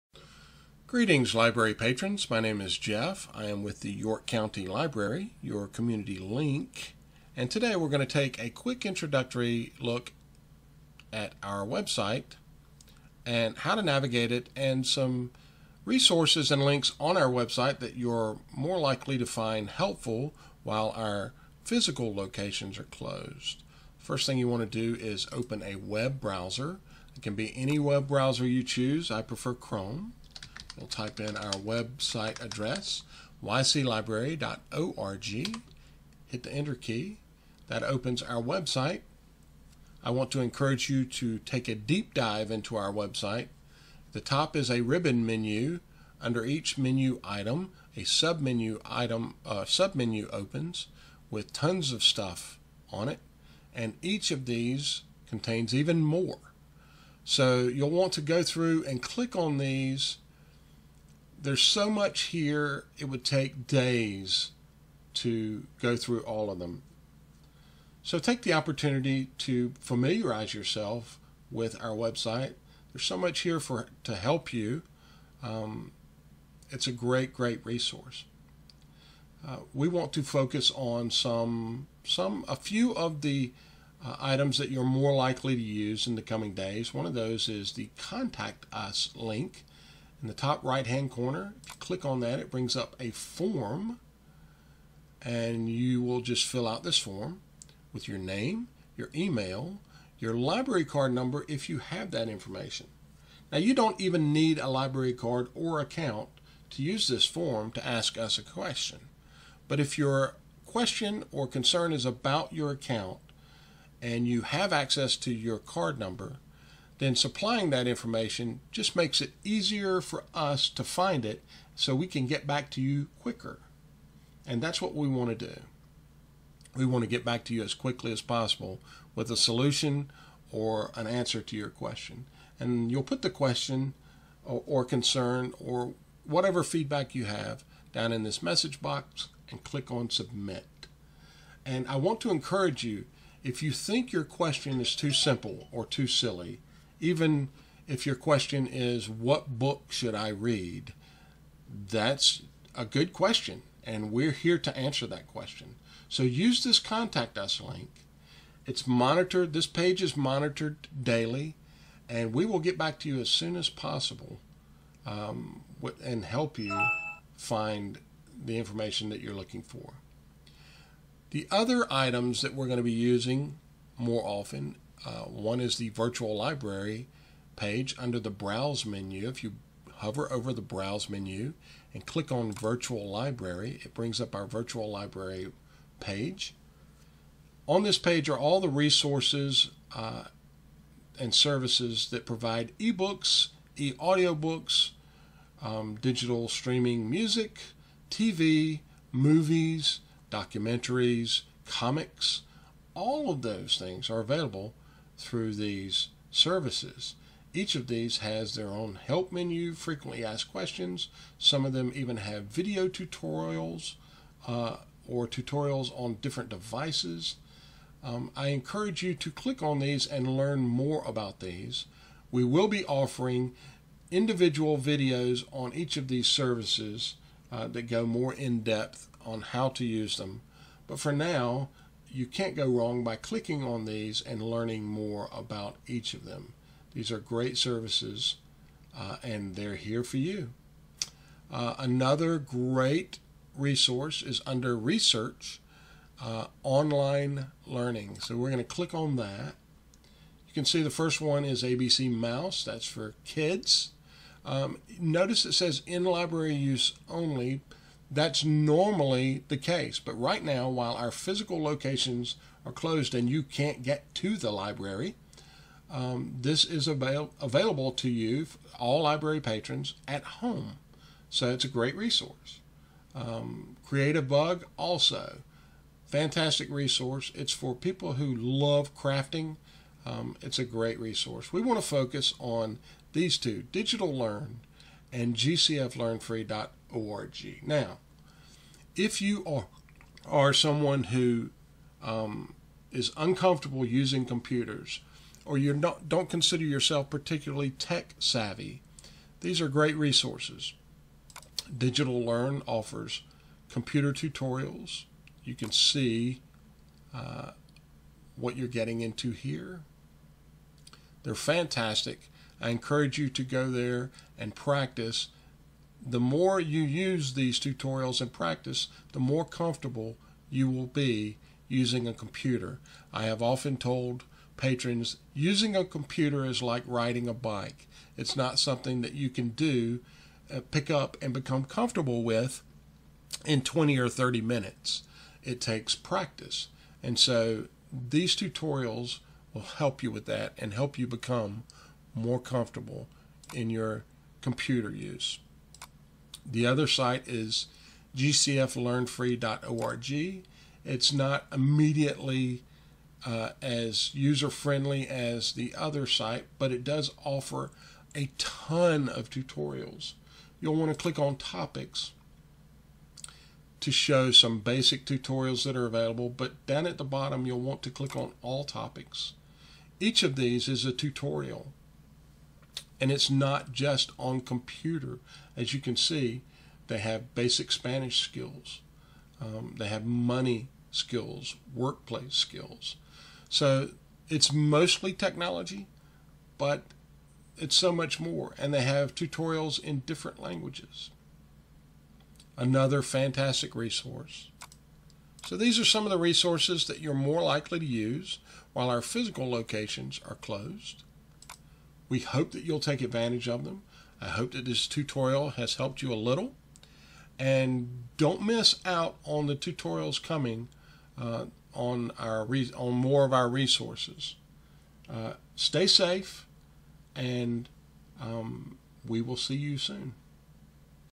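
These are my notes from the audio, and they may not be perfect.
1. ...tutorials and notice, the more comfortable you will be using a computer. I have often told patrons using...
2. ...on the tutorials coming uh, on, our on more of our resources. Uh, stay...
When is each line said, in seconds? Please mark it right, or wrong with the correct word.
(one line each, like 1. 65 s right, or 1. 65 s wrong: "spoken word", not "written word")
1. 317 s wrong: "practice", not "notice"
2. 409 s right.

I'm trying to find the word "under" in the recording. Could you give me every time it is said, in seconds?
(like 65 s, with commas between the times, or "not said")
46 s, 177 s, 244 s.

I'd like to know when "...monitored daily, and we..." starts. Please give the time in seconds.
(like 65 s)
160 s.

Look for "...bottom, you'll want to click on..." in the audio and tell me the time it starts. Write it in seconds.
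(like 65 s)
367 s.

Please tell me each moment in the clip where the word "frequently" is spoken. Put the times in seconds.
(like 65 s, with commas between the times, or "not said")
209 s.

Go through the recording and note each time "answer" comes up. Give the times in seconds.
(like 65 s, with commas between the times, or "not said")
131 s, 154 s.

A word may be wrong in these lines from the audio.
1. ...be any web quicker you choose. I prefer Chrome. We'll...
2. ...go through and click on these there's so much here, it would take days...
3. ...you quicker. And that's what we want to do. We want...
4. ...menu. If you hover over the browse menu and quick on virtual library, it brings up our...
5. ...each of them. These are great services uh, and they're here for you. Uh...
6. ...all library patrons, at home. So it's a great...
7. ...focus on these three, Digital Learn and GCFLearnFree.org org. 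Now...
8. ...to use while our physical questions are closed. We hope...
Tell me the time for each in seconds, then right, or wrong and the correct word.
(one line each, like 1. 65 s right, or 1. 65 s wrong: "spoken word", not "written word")
1. 27 s wrong: "browser", not "quicker"
2. 58 s right
3. 122 s right
4. 178 s wrong: "click", not "quick"
5. 235 s right
6. 268 s right
7. 281 s wrong: "two", not "three"
8. 397 s wrong: "locations", not "questions".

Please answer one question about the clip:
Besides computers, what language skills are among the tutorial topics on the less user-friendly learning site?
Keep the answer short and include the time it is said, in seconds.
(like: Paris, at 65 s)
Basic Spanish, at 377 s.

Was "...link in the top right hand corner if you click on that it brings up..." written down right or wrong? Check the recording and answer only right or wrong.
right.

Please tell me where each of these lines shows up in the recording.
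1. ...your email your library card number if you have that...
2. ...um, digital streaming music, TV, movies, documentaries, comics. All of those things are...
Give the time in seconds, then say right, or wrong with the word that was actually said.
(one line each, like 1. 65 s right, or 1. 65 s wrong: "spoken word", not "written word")
1. 98 s right
2. 195 s right.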